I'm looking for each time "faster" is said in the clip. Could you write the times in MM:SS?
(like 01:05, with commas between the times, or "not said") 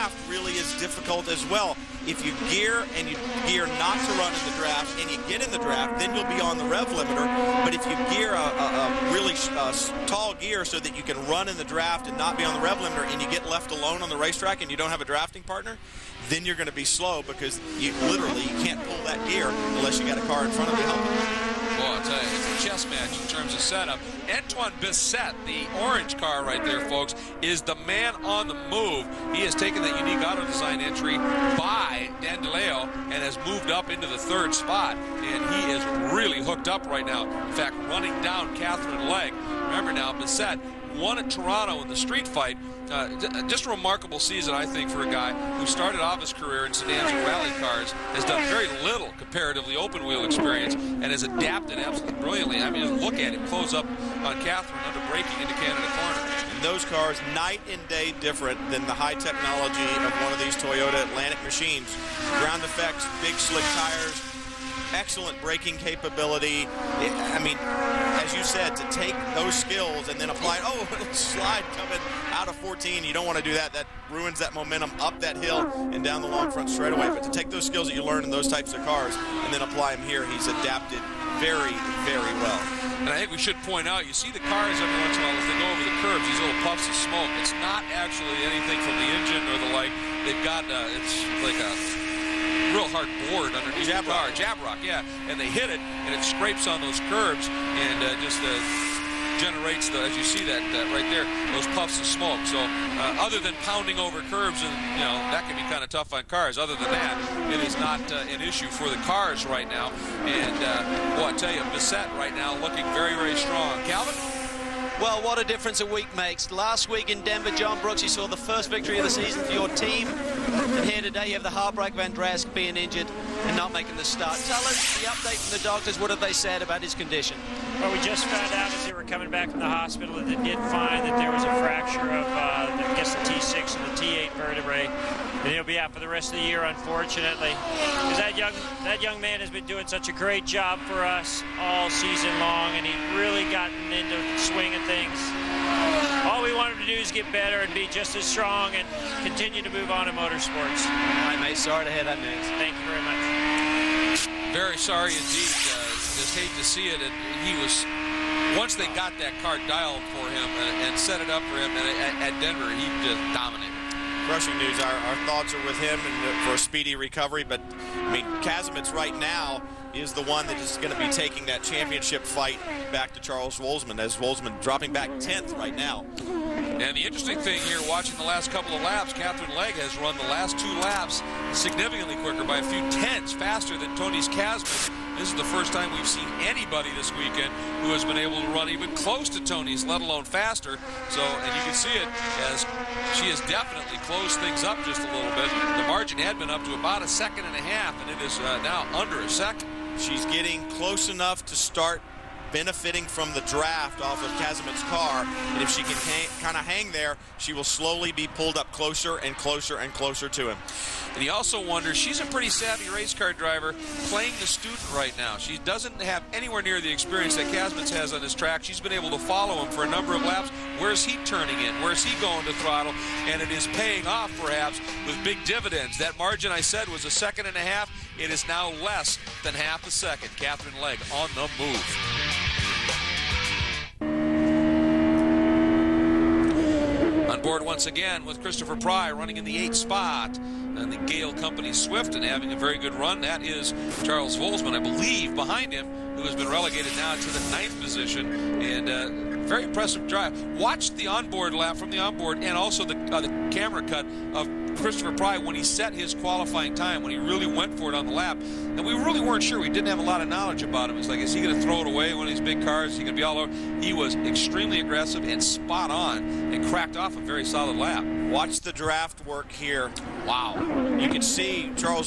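03:03, 03:10.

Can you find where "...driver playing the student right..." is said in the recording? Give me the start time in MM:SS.
03:33.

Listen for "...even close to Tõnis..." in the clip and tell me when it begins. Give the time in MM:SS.
03:08.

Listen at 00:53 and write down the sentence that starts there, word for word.
Close up on Katherine under braking into Canada Corner.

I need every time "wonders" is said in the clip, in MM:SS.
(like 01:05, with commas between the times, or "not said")
03:31.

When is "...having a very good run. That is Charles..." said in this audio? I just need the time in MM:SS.
04:02.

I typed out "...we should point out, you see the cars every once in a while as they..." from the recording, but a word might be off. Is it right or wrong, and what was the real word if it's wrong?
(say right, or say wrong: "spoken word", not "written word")
right.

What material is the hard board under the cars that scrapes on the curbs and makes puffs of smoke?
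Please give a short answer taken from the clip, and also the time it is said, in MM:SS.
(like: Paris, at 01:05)
Jabroc, at 01:34.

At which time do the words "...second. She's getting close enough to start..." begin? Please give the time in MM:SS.
03:19.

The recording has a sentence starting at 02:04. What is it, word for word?
Tell us the update from the doctors.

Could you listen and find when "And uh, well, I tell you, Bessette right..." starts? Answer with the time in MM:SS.
01:50.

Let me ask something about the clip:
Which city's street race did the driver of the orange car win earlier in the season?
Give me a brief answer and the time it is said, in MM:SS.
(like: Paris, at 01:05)
Toronto, at 00:41.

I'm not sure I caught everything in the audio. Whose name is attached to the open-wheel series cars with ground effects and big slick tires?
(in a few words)
Toyota.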